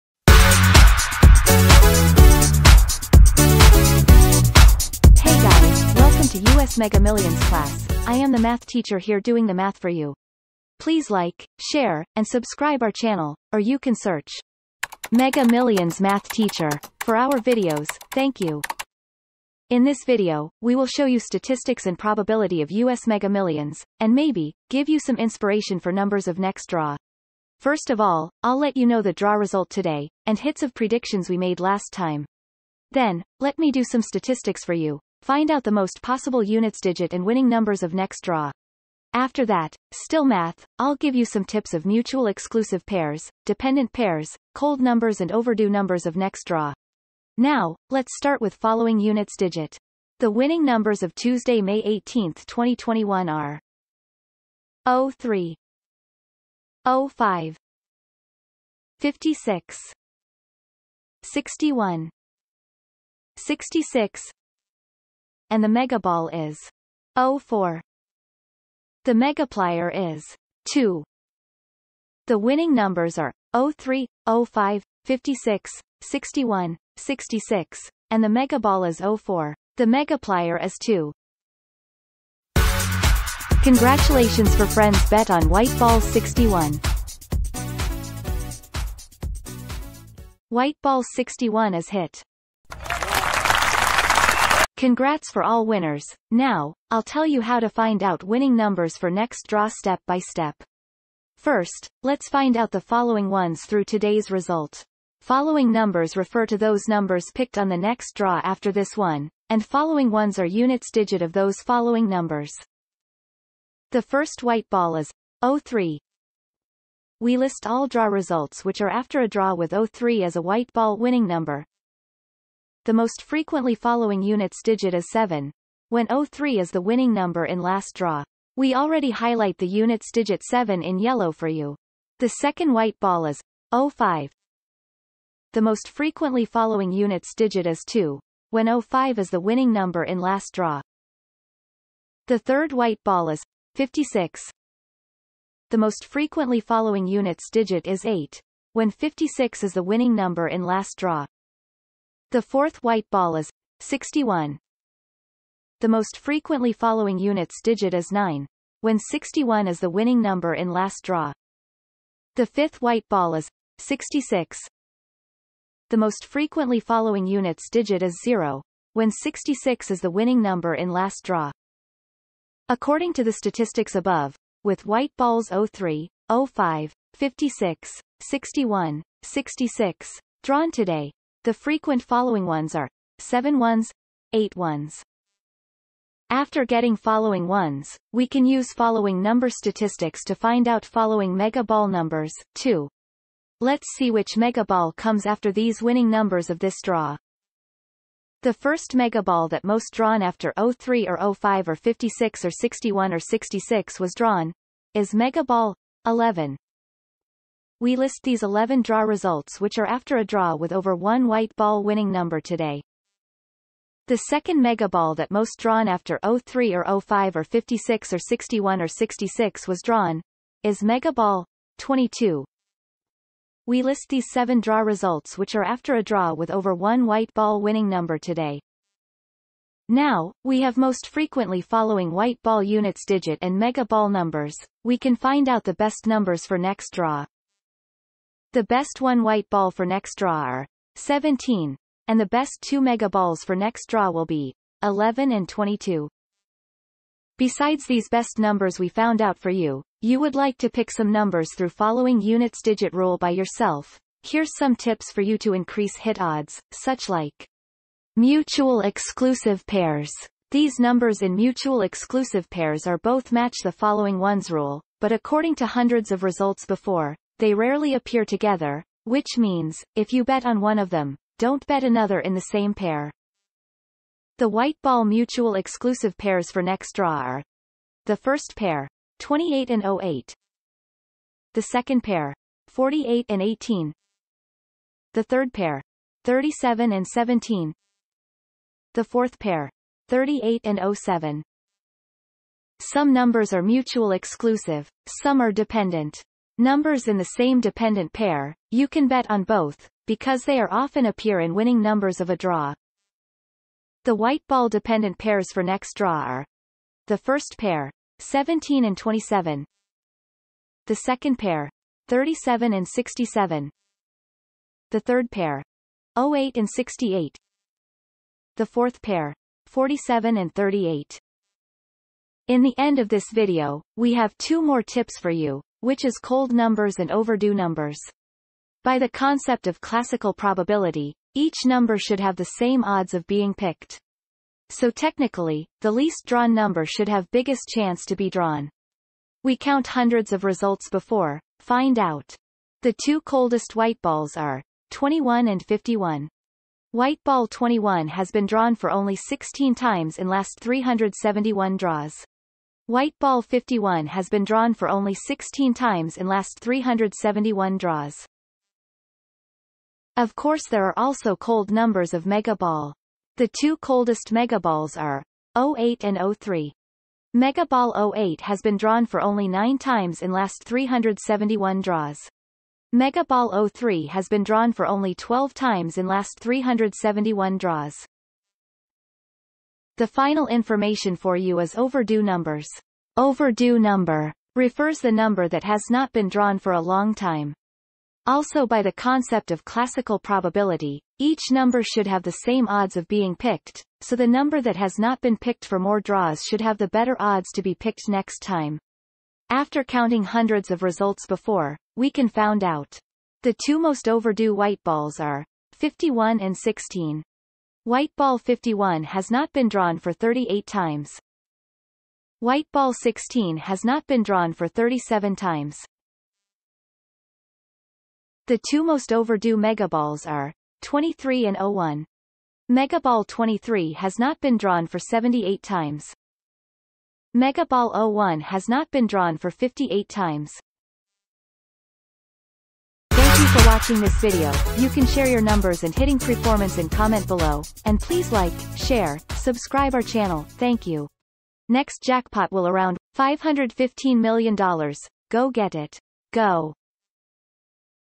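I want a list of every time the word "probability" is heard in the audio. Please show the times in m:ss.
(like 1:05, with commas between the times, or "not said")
0:21, 5:30, 6:30.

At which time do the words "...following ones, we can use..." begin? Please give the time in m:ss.
3:06.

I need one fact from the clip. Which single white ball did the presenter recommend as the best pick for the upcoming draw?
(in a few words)
17.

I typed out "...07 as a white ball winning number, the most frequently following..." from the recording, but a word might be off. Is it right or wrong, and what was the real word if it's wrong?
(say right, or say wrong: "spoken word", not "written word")
wrong: "03", not "07".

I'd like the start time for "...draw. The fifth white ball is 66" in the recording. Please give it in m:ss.
2:41.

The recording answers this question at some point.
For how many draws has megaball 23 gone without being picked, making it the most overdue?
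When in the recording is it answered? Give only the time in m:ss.
7:04.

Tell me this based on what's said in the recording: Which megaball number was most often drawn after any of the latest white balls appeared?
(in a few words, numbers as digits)
11.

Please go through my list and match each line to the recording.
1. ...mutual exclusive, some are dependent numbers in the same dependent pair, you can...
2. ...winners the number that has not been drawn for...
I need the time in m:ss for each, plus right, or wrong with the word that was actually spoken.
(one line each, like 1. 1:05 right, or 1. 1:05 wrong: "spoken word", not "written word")
1. 4:53 right
2. 6:24 wrong: "refers", not "winners".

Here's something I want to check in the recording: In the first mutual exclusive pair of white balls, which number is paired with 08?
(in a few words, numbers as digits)
28.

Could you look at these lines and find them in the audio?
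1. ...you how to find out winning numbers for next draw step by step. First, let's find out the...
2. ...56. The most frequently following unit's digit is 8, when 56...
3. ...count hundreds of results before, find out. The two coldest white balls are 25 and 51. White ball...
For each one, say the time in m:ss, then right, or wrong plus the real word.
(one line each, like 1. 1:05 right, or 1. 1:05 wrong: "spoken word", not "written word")
1. 1:37 right
2. 2:23 right
3. 5:39 wrong: "21", not "25".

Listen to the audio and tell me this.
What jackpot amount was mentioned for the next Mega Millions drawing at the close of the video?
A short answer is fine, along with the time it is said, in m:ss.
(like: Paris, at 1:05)
$515 million, at 7:23.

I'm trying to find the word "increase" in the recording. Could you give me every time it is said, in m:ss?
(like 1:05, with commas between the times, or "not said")
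4:15.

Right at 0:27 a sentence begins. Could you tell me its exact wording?
First of all, I'll let you know the draw result today, and hits of predictions we made last time.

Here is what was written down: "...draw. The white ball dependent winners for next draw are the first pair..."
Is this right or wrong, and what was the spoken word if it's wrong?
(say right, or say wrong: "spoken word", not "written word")
wrong: "pairs", not "winners".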